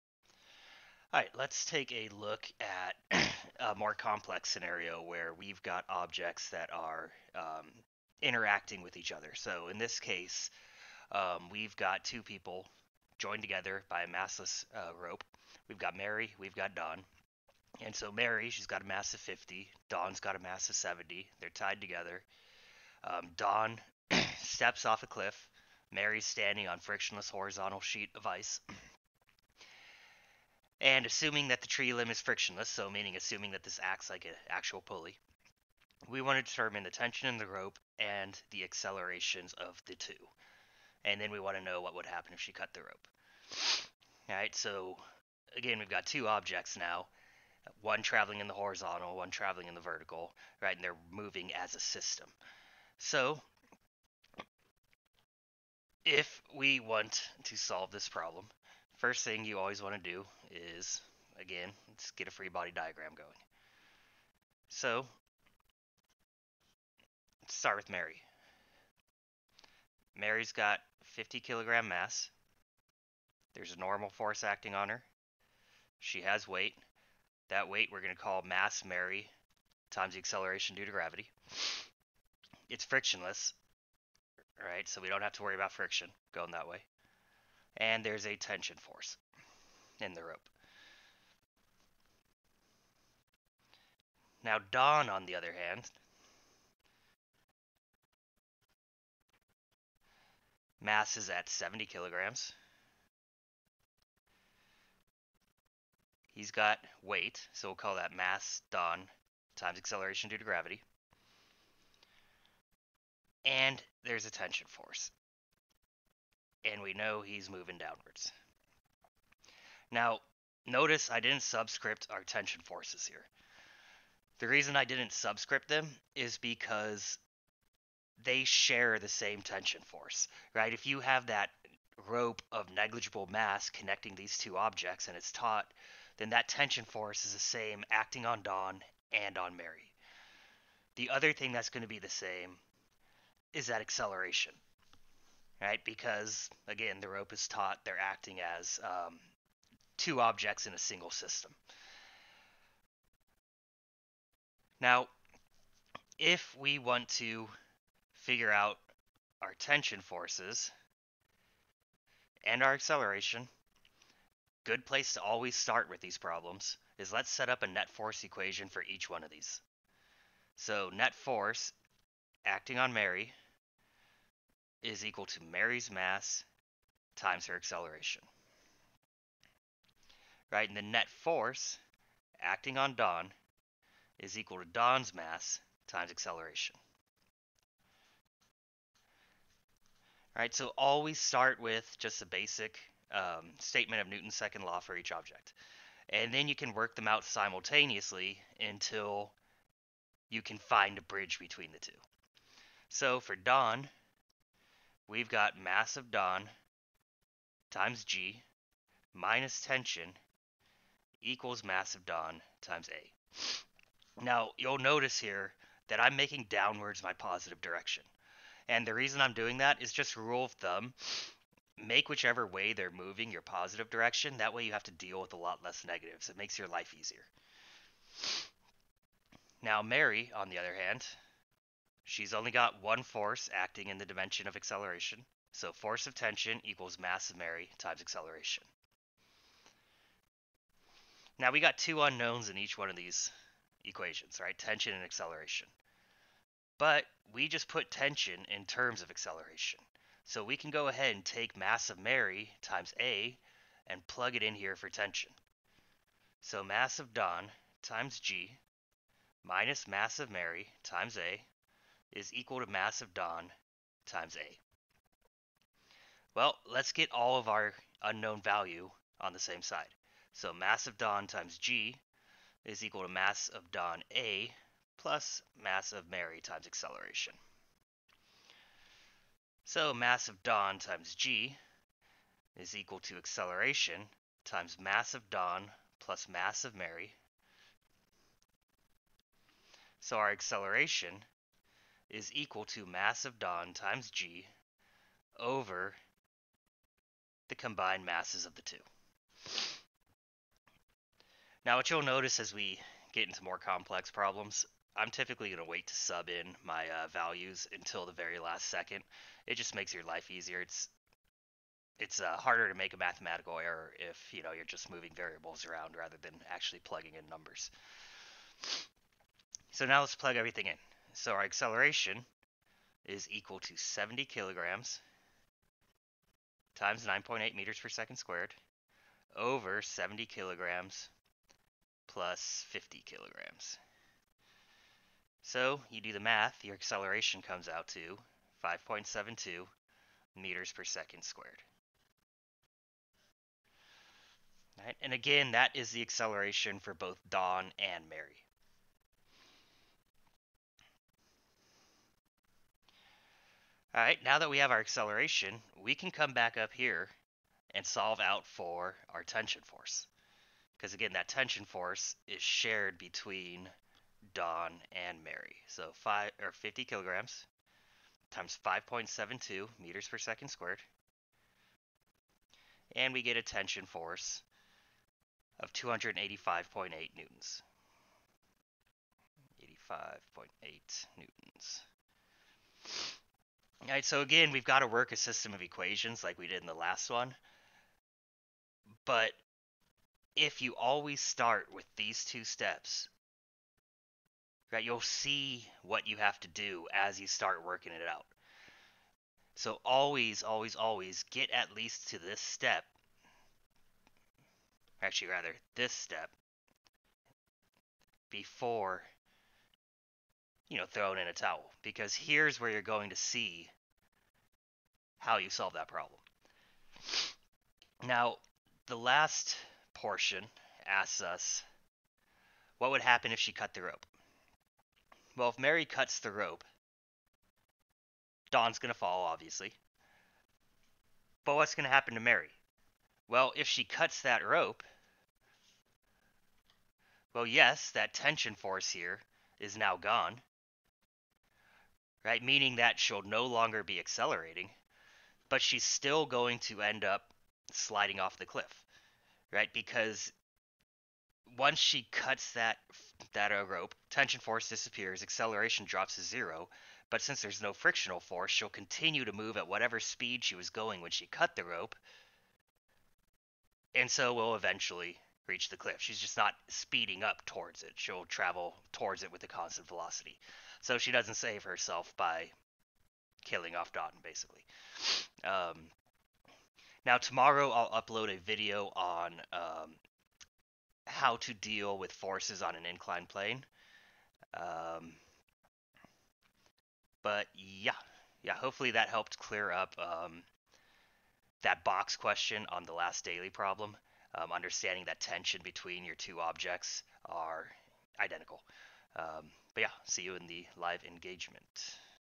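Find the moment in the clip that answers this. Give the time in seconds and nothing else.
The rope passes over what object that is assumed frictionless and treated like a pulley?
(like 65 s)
31 s.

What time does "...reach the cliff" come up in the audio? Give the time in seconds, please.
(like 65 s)
465 s.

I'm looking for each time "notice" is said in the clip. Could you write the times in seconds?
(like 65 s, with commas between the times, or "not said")
120 s, 214 s, 302 s.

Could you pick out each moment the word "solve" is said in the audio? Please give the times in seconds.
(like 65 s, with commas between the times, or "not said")
57 s, 357 s, 415 s.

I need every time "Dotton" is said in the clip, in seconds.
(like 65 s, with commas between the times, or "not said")
473 s.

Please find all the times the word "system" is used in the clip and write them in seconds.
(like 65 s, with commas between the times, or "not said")
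51 s, 151 s, 385 s.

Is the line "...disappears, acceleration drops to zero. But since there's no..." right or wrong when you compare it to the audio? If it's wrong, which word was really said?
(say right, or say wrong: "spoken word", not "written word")
right.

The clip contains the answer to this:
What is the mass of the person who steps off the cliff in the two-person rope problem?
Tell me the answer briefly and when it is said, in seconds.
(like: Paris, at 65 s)
70, at 19 s.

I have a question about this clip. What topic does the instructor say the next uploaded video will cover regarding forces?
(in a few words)
inclined plane.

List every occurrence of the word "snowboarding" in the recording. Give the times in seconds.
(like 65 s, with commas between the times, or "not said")
not said.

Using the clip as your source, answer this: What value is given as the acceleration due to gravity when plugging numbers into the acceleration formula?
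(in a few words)
9.8 meters per second squared.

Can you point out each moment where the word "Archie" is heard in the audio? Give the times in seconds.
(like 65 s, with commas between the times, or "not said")
not said.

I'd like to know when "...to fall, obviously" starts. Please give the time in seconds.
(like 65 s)
428 s.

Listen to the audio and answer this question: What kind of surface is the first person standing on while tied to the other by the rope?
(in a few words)
frictionless horizontal sheet of ice.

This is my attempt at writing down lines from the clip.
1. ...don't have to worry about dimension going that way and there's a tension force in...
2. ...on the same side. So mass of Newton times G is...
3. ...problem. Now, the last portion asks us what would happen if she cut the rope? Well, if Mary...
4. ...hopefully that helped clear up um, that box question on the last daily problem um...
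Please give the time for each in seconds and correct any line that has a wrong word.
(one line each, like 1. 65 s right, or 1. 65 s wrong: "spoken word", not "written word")
1. 85 s wrong: "friction", not "dimension"
2. 269 s wrong: "Don", not "Newton"
3. 415 s right
4. 488 s right.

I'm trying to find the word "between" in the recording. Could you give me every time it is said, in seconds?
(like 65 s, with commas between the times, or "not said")
201 s, 362 s, 495 s.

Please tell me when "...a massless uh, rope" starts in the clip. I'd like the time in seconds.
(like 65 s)
14 s.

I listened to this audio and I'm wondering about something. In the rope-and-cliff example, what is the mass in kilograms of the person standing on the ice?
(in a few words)
50.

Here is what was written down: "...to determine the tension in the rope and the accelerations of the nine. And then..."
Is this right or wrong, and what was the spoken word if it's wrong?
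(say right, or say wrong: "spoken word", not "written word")
wrong: "two", not "nine".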